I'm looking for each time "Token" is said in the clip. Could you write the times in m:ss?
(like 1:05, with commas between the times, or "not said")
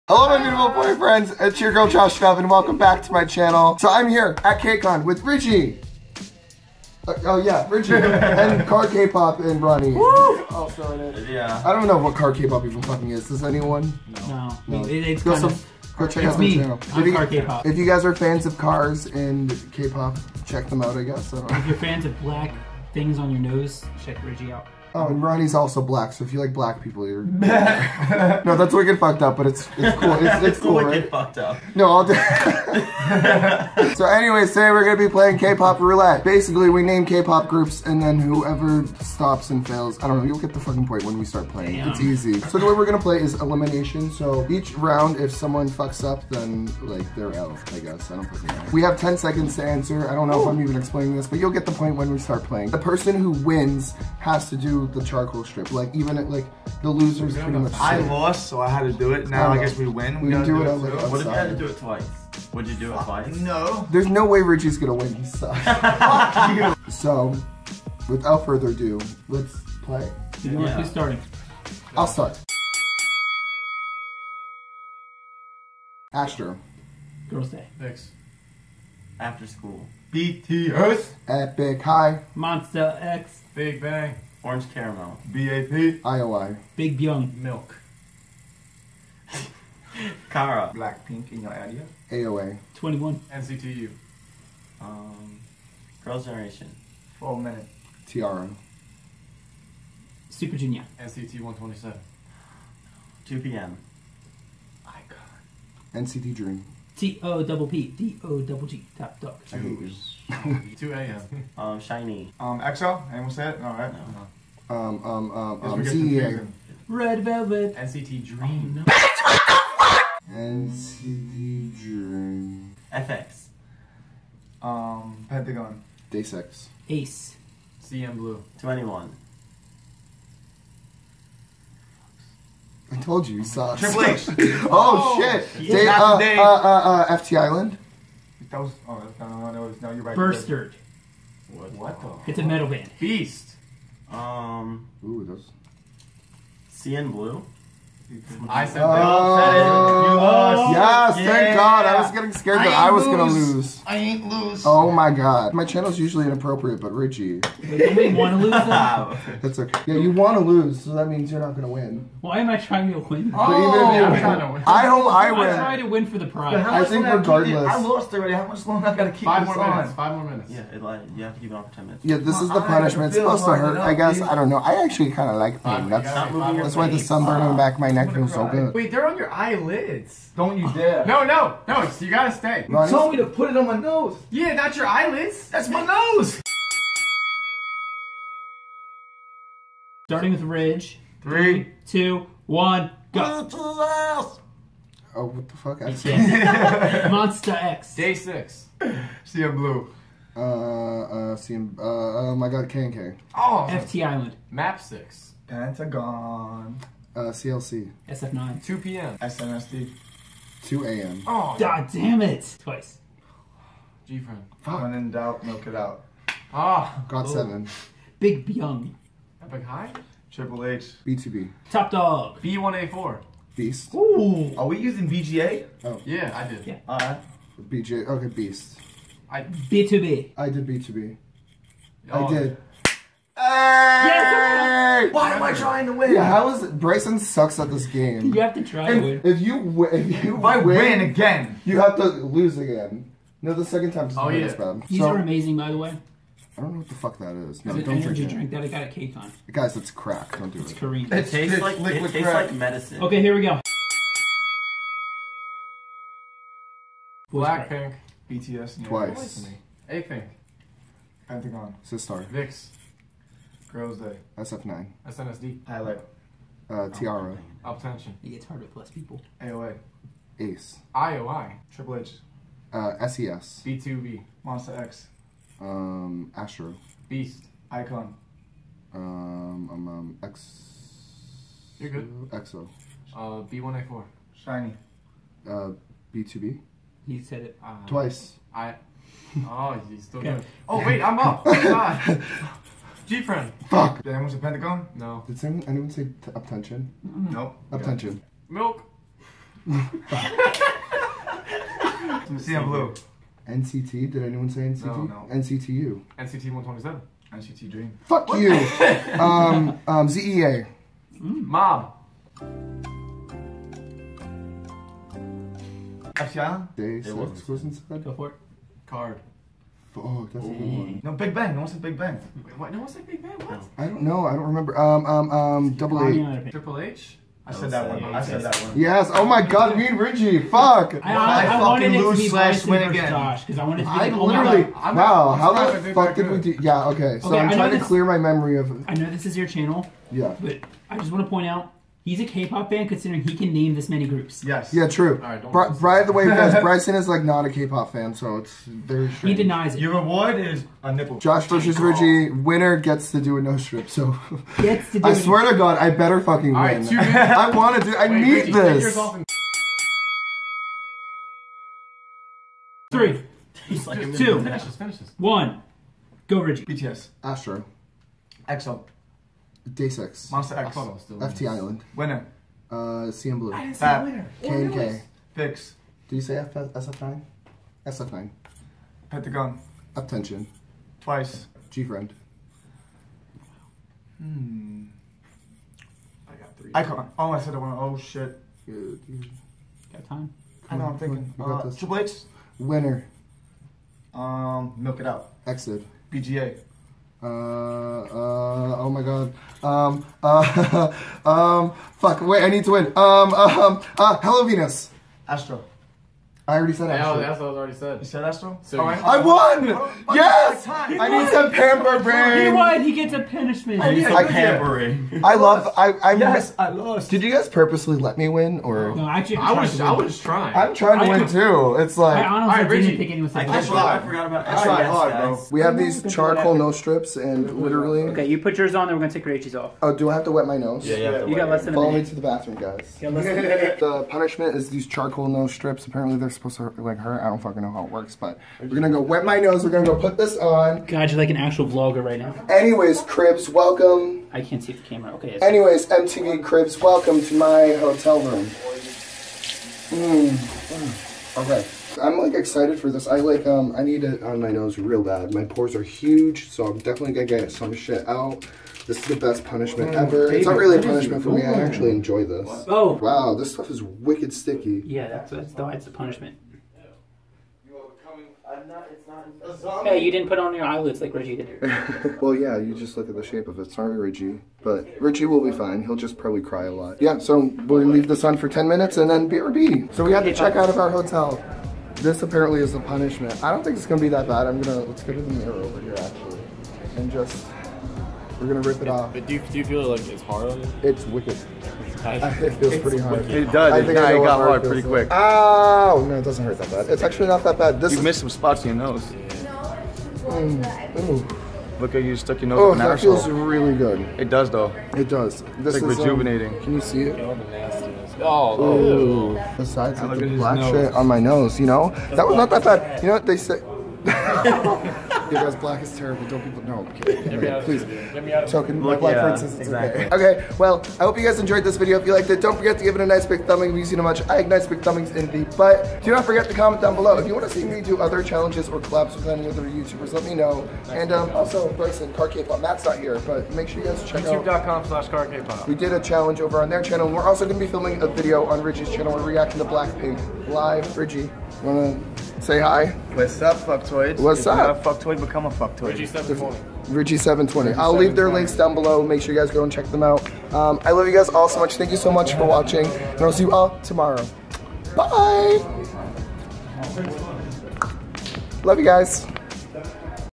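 8:38.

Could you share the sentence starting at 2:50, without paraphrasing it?
Yeah, it, like, you have to keep it on for 10 minutes.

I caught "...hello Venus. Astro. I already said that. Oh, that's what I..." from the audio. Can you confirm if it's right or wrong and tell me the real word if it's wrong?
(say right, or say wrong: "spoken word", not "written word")
right.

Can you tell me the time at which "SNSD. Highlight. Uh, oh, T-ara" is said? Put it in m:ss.
4:25.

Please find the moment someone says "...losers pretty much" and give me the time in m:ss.
0:56.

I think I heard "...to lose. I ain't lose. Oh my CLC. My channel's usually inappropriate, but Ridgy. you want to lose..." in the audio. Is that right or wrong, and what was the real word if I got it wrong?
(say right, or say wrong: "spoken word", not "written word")
wrong: "God", not "CLC".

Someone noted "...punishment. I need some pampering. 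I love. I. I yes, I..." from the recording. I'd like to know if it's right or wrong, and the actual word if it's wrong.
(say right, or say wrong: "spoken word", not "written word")
right.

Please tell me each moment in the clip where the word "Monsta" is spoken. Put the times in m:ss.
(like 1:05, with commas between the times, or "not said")
1:22, 3:17, 4:34, 6:10.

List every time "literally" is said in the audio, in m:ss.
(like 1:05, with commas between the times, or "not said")
5:34, 7:07.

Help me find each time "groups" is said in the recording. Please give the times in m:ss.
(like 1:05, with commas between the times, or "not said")
0:37, 5:44.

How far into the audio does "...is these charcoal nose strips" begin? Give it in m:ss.
7:14.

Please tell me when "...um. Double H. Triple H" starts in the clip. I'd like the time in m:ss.
5:25.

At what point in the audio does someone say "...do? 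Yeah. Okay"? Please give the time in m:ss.
5:36.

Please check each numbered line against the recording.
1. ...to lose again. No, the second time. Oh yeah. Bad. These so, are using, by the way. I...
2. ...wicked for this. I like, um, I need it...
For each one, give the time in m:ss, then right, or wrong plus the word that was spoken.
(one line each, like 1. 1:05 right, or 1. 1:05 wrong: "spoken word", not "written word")
1. 4:01 wrong: "amazing", not "using"
2. 7:32 wrong: "excited", not "wicked".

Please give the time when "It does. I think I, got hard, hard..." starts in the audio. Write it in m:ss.
8:13.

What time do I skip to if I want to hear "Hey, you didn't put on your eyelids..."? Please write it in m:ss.
7:49.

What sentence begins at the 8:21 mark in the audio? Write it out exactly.
Look at you stuck your nose oh, that feels really good.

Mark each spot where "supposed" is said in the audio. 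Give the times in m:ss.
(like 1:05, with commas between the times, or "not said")
2:53, 7:16.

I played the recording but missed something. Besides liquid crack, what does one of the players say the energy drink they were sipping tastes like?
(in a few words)
Medicine.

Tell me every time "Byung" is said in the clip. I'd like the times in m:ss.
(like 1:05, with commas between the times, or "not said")
1:26, 3:38.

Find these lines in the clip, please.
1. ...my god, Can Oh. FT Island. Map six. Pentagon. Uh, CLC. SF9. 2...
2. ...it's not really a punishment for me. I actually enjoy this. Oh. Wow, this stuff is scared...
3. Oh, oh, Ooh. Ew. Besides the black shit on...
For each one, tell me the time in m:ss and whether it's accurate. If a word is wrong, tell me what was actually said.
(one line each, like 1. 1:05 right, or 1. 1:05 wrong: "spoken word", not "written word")
1. 3:22 right
2. 7:40 wrong: "wicked", not "scared"
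3. 8:28 right.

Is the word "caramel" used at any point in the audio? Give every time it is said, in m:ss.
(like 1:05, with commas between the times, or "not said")
1:24.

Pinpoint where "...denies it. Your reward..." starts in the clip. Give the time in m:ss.
5:49.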